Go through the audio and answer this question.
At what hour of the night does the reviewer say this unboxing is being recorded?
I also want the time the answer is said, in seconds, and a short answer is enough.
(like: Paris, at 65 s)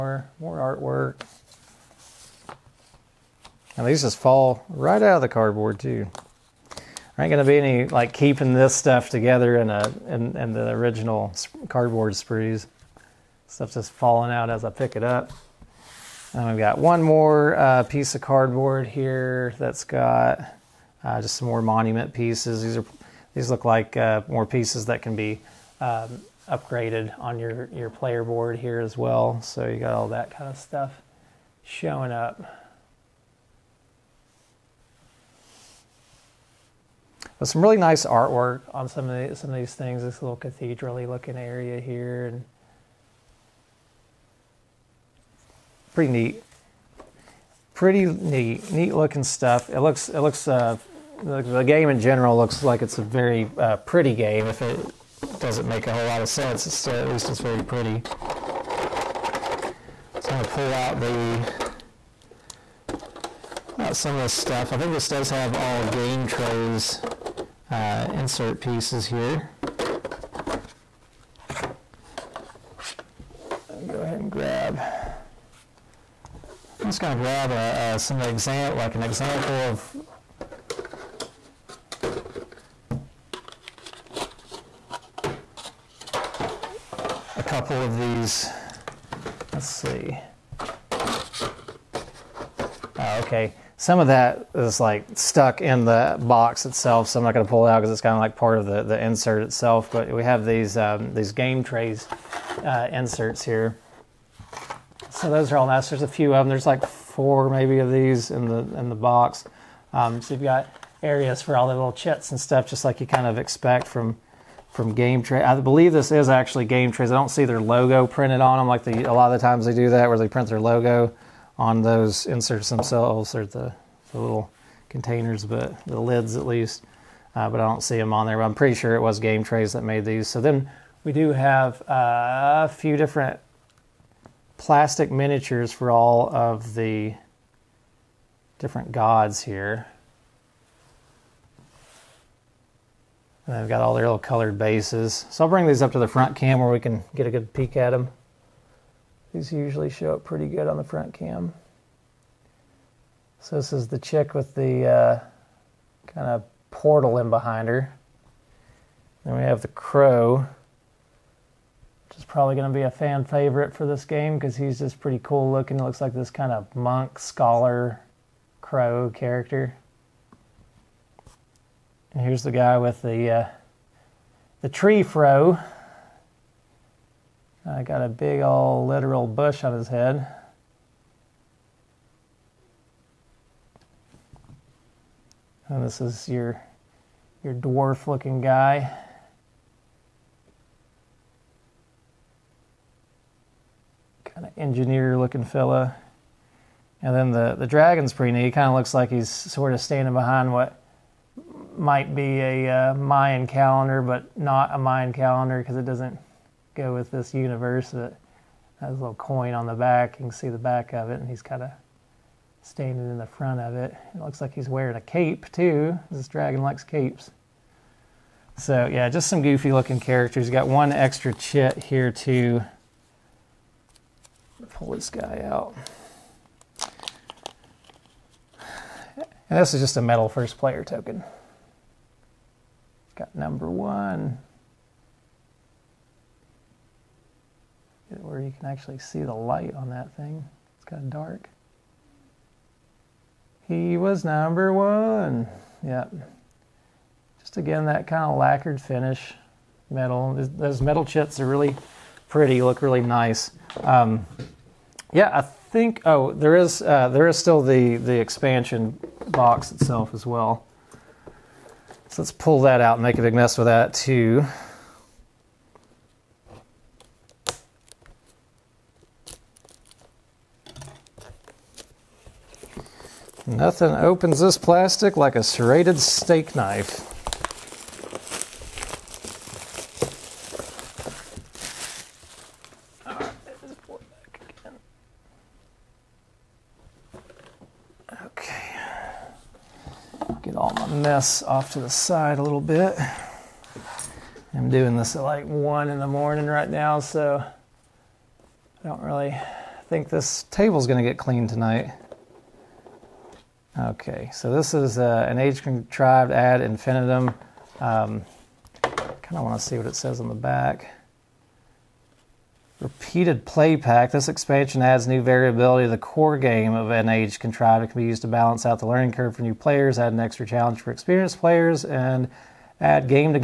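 1 in the morning, at 295 s.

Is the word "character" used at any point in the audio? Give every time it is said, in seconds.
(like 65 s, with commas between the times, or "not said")
169 s, 220 s.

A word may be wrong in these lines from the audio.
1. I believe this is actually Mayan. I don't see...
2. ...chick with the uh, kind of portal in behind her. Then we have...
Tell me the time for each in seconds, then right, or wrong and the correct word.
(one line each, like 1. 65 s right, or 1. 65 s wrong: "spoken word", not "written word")
1. 115 s wrong: "GameTrayz", not "Mayan"
2. 153 s right.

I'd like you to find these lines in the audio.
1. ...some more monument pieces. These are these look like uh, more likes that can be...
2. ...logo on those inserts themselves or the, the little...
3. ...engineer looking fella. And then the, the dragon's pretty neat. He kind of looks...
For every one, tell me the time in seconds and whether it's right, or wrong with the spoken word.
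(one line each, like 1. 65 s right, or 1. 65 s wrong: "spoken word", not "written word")
1. 21 s wrong: "pieces", not "likes"
2. 120 s right
3. 194 s right.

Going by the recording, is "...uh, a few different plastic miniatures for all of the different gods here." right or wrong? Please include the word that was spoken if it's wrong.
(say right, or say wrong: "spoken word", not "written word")
right.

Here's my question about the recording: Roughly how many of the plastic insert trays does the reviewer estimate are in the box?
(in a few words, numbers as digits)
4.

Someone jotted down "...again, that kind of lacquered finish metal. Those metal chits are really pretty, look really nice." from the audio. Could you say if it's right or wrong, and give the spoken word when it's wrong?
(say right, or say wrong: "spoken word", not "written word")
right.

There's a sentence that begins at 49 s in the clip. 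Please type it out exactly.
It looks it looks uh, the game in general looks like it's a very uh, pretty game.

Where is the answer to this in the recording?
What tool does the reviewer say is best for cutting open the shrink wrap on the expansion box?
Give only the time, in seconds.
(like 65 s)
275 s.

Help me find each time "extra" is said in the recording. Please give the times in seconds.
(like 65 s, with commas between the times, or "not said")
220 s, 320 s.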